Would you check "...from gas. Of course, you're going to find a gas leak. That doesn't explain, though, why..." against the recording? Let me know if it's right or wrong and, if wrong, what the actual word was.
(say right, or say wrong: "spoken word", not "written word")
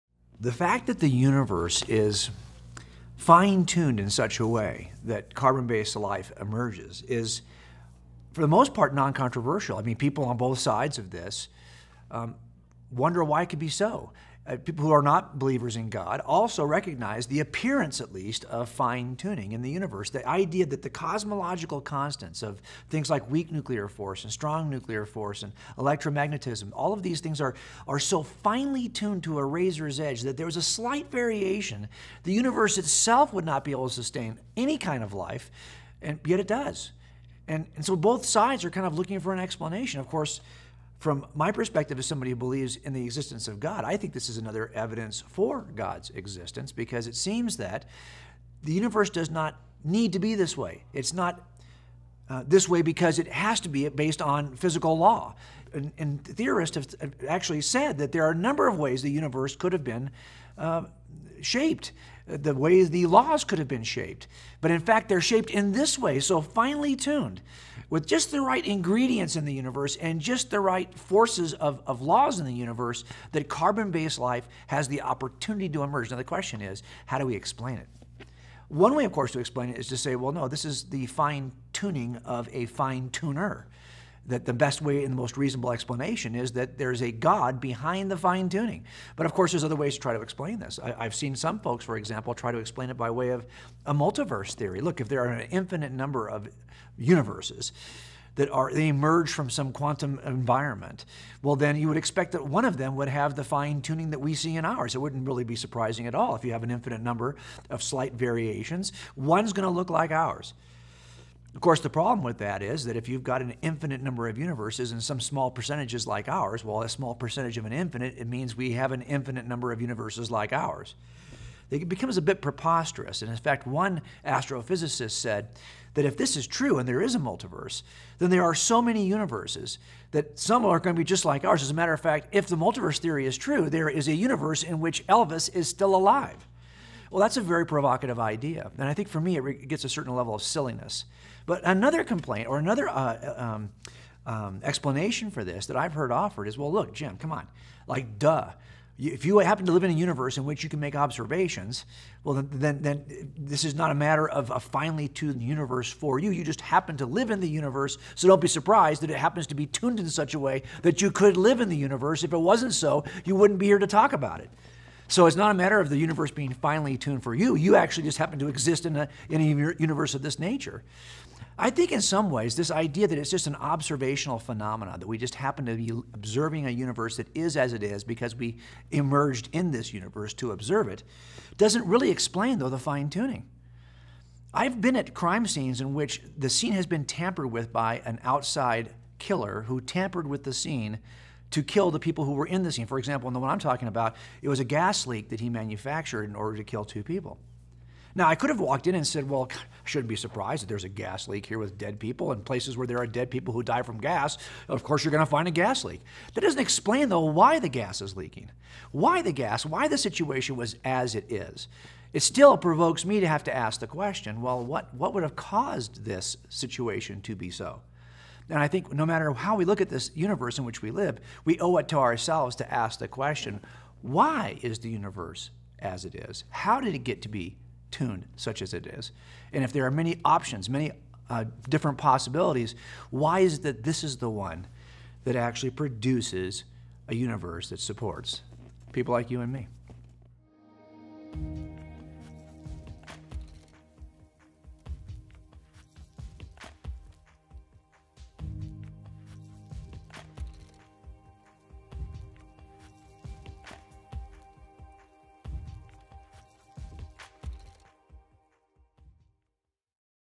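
right.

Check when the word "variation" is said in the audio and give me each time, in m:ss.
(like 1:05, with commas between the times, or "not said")
0:31, 1:48.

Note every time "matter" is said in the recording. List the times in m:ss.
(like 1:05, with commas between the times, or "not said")
2:11, 2:33, 2:45, 3:39.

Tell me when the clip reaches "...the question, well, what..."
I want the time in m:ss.
3:33.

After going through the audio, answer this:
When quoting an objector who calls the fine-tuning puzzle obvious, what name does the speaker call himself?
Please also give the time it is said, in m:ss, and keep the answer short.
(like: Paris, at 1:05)
Jim, at 2:26.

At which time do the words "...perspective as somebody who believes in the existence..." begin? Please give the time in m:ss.
0:41.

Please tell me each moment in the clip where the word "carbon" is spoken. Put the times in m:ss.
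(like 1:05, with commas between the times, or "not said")
0:05, 1:13.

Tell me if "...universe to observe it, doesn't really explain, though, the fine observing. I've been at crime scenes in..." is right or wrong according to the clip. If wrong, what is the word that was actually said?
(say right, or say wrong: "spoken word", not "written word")
wrong: "tuning", not "observing".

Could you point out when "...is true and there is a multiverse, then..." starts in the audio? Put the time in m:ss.
2:06.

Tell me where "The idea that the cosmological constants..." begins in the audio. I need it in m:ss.
0:20.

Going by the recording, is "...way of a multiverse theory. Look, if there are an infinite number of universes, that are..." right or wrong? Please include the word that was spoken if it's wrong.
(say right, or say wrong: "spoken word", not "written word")
right.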